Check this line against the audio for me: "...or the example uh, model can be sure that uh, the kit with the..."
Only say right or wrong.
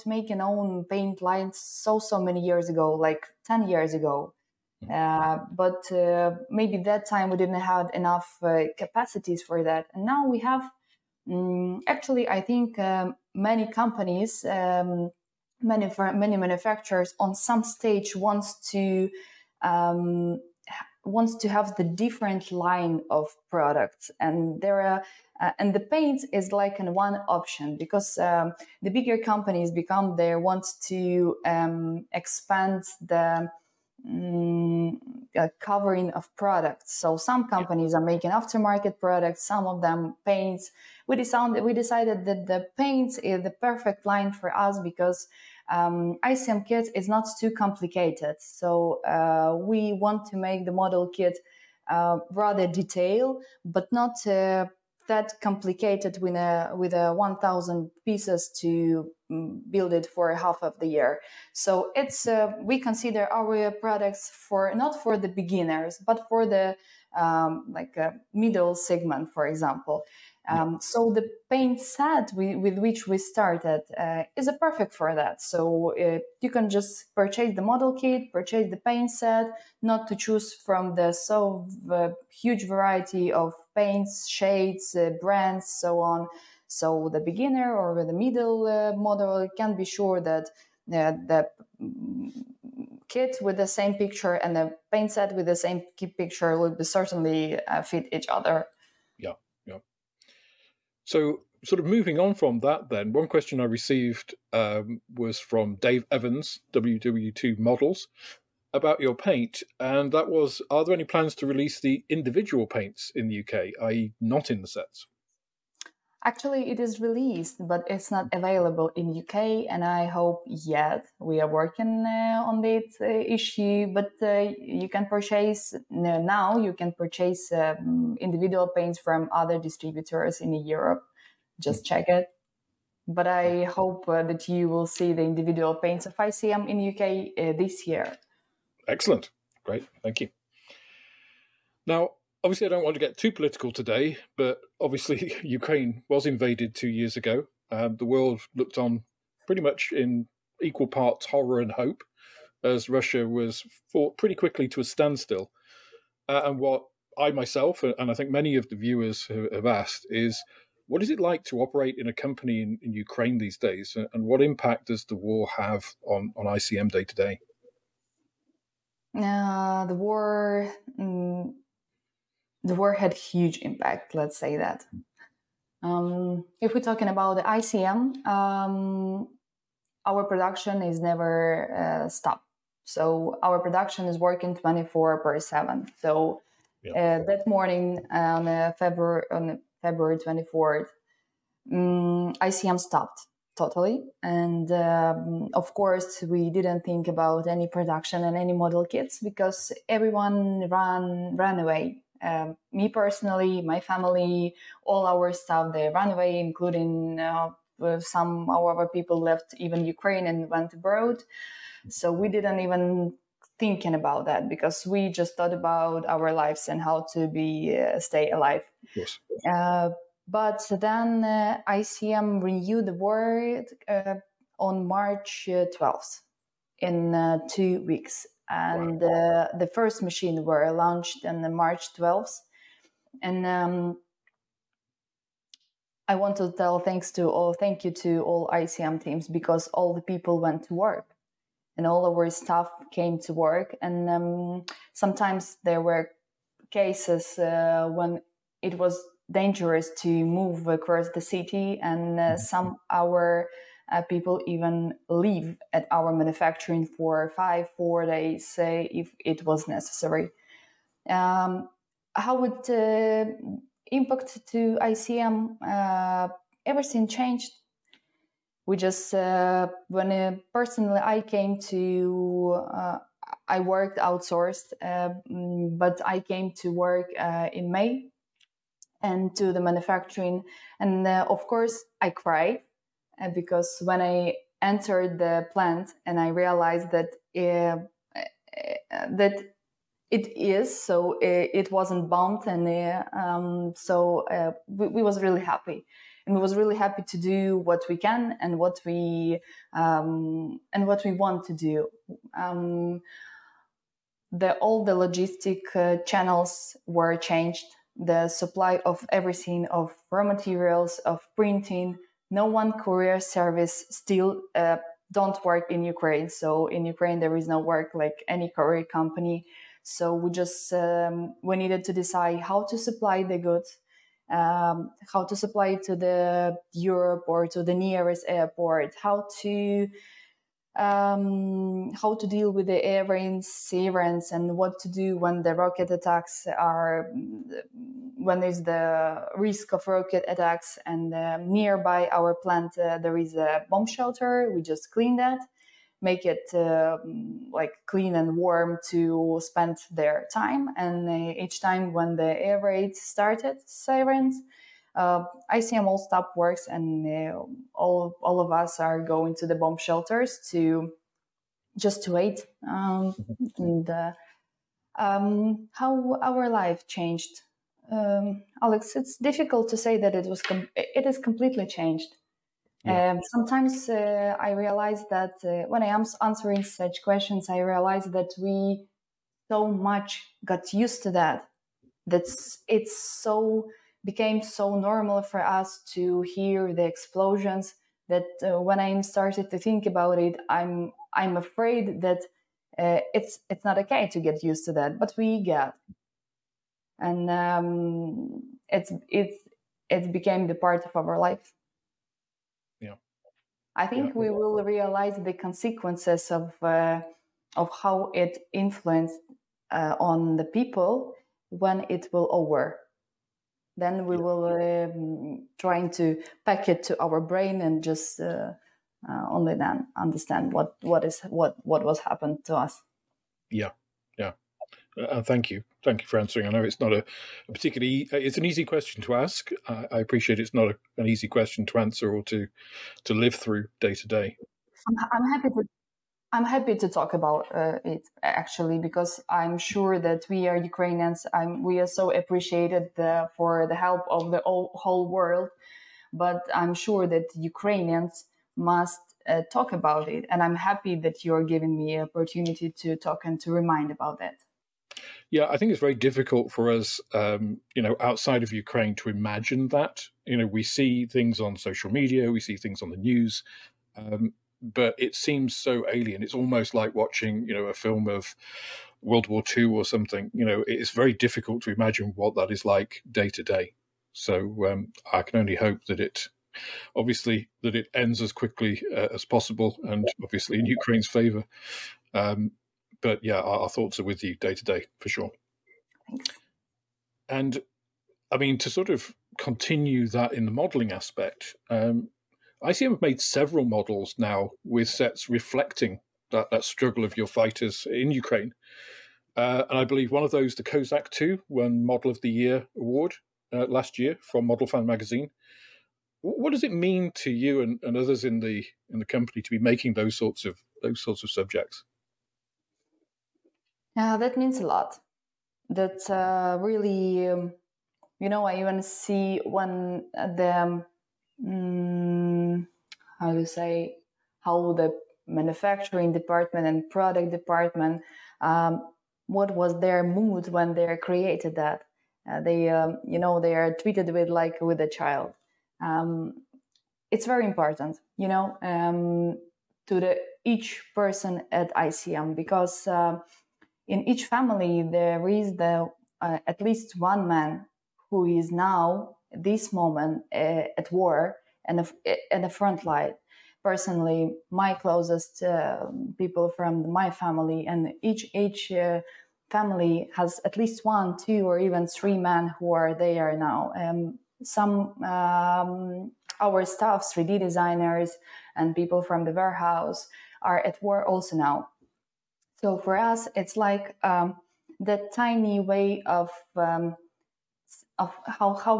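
wrong.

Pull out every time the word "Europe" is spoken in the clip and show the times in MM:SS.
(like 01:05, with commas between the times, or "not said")
02:10, 05:26.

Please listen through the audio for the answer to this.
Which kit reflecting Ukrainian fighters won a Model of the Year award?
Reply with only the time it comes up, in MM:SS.
08:20.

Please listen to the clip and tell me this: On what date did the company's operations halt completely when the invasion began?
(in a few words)
February 24th.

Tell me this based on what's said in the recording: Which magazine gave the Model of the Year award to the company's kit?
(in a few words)
Model Fan.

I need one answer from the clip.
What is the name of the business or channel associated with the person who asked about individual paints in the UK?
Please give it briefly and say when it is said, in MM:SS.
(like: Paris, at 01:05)
WW2 Models, at 01:46.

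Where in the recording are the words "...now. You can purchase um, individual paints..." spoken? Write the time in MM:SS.
02:05.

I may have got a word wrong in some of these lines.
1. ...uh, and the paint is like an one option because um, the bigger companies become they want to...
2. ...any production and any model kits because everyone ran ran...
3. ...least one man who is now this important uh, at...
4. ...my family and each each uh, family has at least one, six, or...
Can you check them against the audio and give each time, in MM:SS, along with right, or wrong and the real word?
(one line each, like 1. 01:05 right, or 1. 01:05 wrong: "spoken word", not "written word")
1. 00:25 right
2. 03:17 right
3. 09:06 wrong: "moment", not "important"
4. 09:16 wrong: "two", not "six".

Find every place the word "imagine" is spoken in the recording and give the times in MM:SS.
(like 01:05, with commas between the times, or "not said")
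07:39, 07:51.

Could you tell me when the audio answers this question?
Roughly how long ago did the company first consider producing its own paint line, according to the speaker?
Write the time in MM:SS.
00:02.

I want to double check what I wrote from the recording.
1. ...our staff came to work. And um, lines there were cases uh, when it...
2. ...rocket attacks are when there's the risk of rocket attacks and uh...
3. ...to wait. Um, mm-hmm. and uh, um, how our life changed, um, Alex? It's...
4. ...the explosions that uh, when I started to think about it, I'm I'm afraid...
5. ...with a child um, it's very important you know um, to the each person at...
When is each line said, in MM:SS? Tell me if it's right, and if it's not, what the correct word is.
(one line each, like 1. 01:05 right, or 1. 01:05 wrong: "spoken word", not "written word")
1. 04:02 wrong: "sometimes", not "lines"
2. 05:35 right
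3. 06:02 right
4. 06:26 right
5. 08:54 right.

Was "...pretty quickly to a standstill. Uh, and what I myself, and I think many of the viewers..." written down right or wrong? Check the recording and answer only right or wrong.
right.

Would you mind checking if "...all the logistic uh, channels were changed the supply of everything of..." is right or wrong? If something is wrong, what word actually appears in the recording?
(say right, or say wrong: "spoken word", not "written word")
right.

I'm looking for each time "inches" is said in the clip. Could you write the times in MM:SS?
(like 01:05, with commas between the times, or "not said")
not said.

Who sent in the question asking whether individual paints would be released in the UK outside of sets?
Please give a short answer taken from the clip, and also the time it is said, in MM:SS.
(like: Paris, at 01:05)
Dave Evans, at 01:45.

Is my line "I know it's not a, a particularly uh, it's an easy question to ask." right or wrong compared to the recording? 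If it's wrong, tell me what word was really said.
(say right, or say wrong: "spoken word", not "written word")
right.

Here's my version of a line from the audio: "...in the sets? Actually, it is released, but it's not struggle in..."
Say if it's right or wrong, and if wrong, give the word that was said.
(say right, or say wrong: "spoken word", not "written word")
wrong: "available", not "struggle".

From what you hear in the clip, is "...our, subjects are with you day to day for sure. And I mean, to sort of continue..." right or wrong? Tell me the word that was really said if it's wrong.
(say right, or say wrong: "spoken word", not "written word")
wrong: "thoughts", not "subjects".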